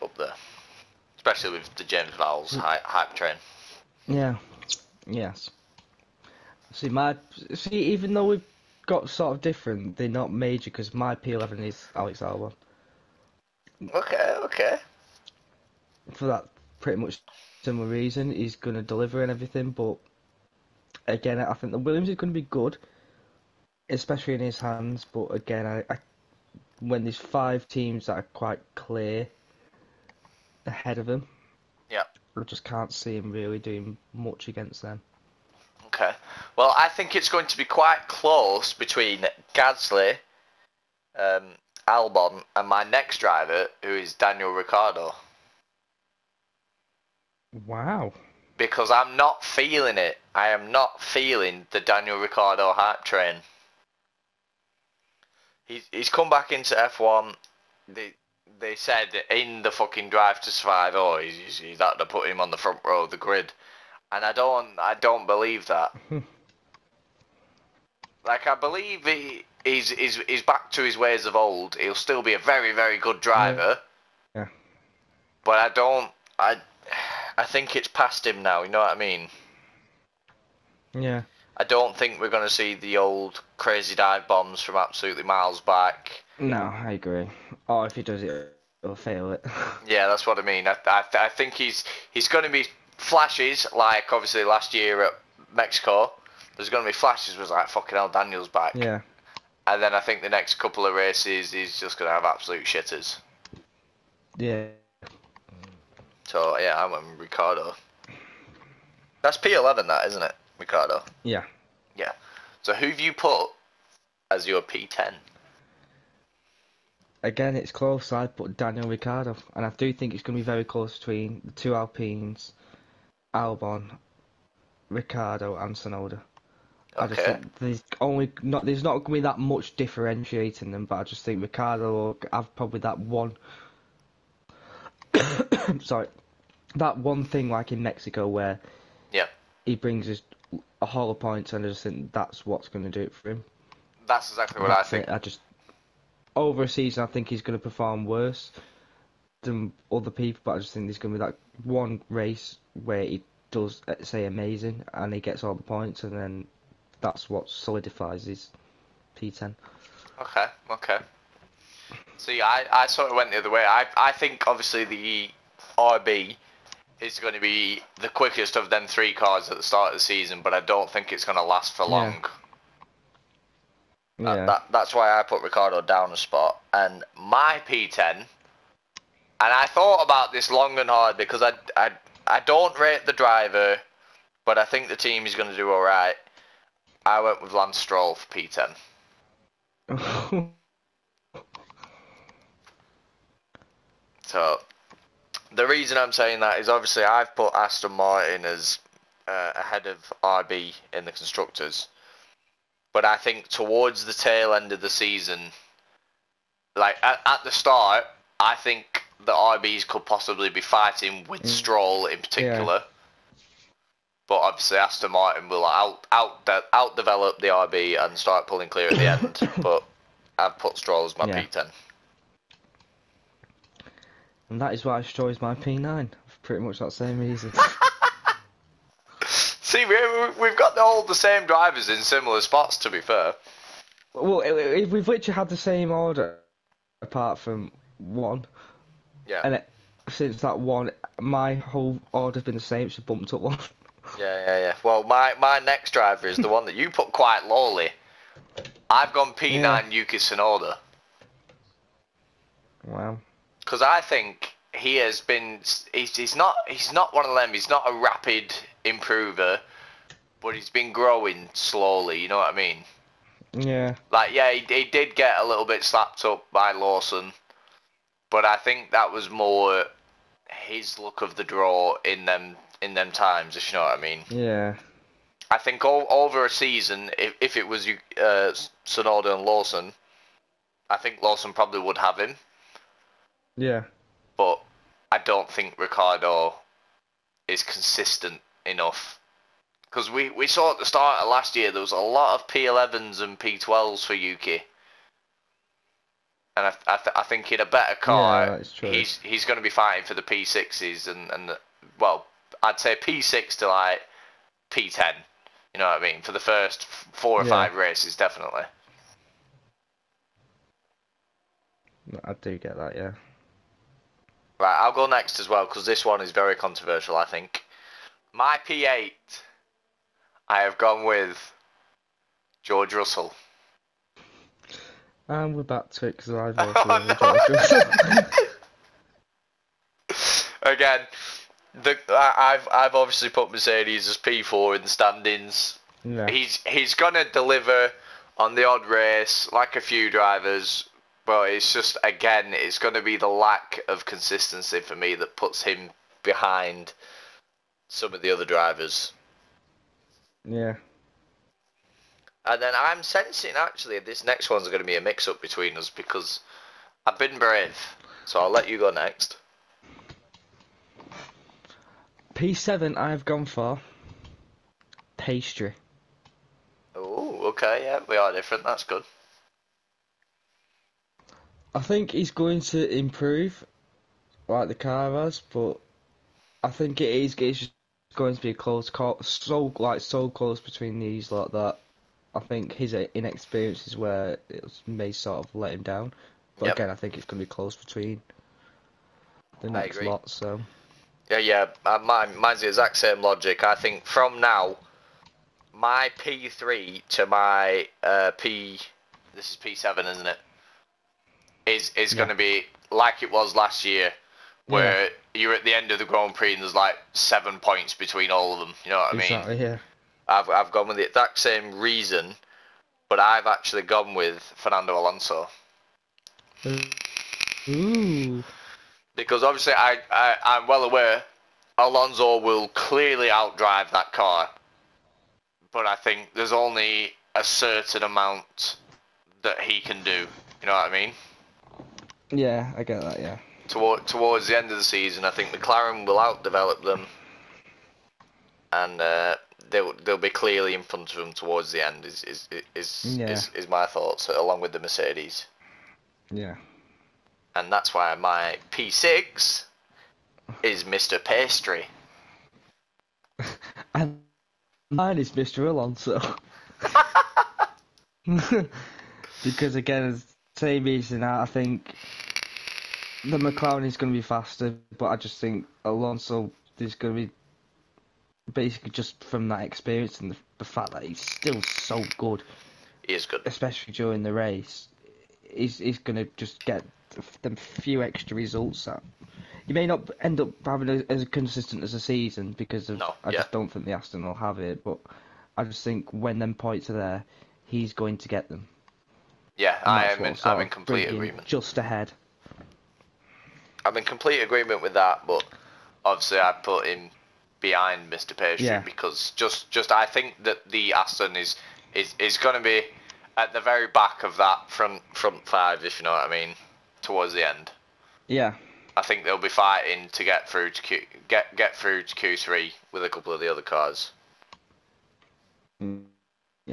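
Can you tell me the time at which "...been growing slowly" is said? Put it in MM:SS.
04:20.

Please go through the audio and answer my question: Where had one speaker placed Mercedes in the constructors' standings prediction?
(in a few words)
4th.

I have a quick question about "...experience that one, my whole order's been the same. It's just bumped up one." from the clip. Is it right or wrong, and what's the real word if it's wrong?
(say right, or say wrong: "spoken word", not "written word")
wrong: "since", not "experience".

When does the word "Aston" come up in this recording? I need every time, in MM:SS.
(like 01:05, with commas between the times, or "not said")
03:17, 03:34, 08:03, 08:20.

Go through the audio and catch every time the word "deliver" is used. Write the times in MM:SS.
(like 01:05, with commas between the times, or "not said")
00:18, 05:37.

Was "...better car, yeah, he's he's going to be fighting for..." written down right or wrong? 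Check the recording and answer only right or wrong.
right.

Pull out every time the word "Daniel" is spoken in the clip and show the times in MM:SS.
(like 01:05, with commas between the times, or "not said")
00:44, 00:51, 01:38, 01:58.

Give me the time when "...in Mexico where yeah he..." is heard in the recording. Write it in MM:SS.
02:17.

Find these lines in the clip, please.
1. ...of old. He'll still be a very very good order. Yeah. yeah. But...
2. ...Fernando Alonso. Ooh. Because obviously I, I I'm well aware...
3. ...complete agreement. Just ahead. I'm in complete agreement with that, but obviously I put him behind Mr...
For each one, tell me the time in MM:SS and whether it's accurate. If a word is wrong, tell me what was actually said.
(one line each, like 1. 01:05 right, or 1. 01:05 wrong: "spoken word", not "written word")
1. 01:11 wrong: "driver", not "order"
2. 06:54 right
3. 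08:10 right.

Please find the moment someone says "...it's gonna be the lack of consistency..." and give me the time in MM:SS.
05:42.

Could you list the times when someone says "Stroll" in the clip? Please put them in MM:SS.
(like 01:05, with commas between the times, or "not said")
03:07, 03:31, 03:40, 03:45.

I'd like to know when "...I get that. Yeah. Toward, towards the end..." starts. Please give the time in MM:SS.
07:12.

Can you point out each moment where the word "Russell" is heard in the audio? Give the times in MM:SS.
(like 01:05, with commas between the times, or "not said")
05:22.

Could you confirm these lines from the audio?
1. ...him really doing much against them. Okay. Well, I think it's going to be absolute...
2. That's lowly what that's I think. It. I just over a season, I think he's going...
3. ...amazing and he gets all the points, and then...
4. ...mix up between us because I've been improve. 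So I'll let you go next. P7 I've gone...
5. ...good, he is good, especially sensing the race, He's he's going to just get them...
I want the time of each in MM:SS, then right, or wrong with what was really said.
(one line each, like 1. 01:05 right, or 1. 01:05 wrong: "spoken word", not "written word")
1. 00:33 wrong: "quite", not "absolute"
2. 02:24 wrong: "exactly", not "lowly"
3. 02:34 right
4. 05:55 wrong: "brave", not "improve"
5. 07:52 wrong: "during", not "sensing".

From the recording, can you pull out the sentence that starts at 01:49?
That's P11, that isn't it, Ricciardo?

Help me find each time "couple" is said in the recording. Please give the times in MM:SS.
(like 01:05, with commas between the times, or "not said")
01:40, 08:33.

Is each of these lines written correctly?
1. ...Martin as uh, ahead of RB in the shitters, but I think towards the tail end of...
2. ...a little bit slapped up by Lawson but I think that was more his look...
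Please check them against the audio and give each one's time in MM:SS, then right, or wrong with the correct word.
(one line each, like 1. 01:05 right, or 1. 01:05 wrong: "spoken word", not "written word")
1. 03:17 wrong: "constructors", not "shitters"
2. 04:25 right.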